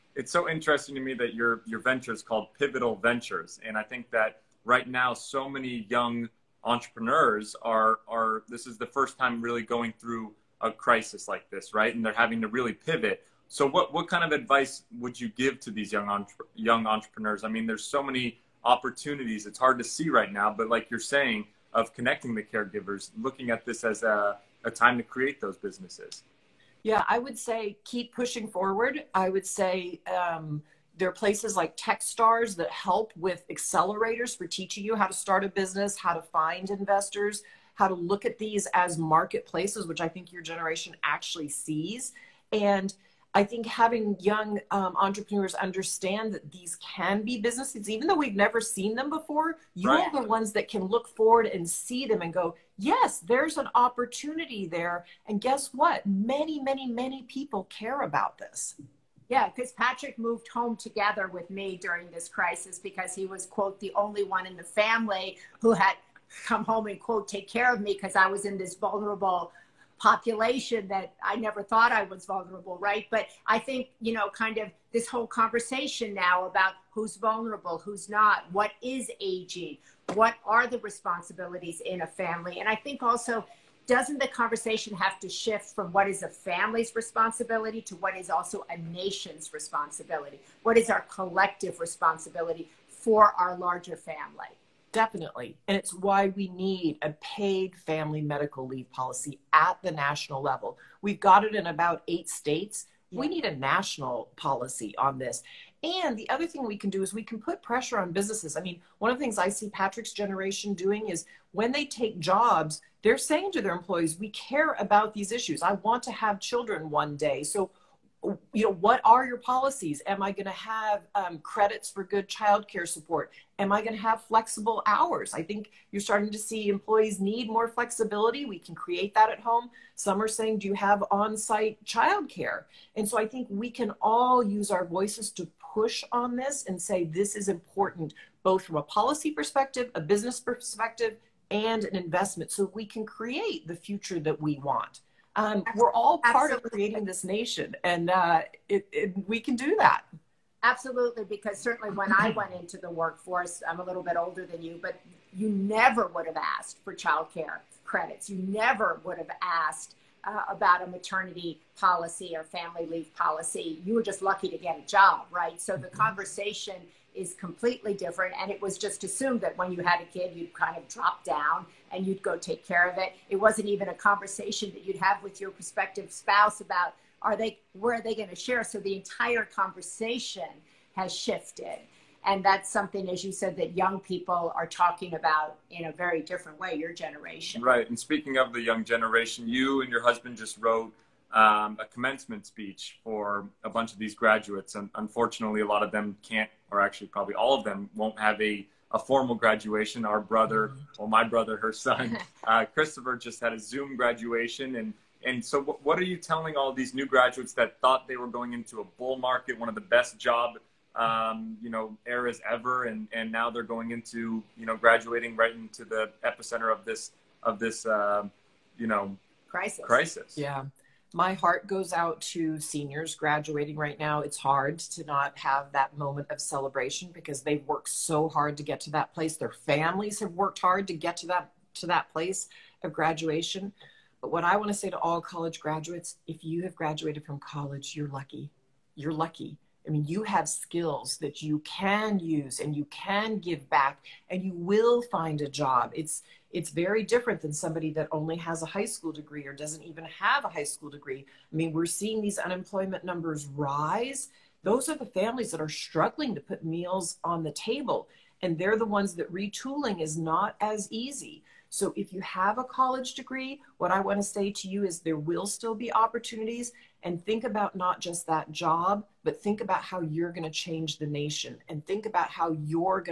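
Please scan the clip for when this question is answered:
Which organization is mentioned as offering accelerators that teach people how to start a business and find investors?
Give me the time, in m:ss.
0:31.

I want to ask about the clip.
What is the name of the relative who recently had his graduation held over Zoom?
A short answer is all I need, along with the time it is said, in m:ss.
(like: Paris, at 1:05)
Christopher, at 3:22.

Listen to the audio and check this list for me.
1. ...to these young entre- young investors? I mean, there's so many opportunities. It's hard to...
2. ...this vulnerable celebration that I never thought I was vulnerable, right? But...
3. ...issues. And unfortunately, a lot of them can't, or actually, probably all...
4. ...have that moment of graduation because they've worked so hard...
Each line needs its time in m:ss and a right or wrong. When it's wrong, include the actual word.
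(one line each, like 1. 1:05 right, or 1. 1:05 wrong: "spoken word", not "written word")
1. 0:15 wrong: "entrepreneurs", not "investors"
2. 1:08 wrong: "population", not "celebration"
3. 3:14 wrong: "graduates", not "issues"
4. 3:45 wrong: "celebration", not "graduation".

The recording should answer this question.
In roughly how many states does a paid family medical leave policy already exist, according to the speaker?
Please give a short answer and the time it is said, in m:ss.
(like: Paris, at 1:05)
8, at 1:42.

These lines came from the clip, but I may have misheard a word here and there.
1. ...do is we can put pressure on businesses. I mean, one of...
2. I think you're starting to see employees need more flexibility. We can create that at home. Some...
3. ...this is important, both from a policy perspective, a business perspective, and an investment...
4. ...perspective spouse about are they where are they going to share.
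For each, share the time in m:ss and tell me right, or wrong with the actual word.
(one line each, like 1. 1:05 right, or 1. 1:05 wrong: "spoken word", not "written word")
1. 1:46 right
2. 2:05 right
3. 2:17 right
4. 2:55 wrong: "prospective", not "perspective".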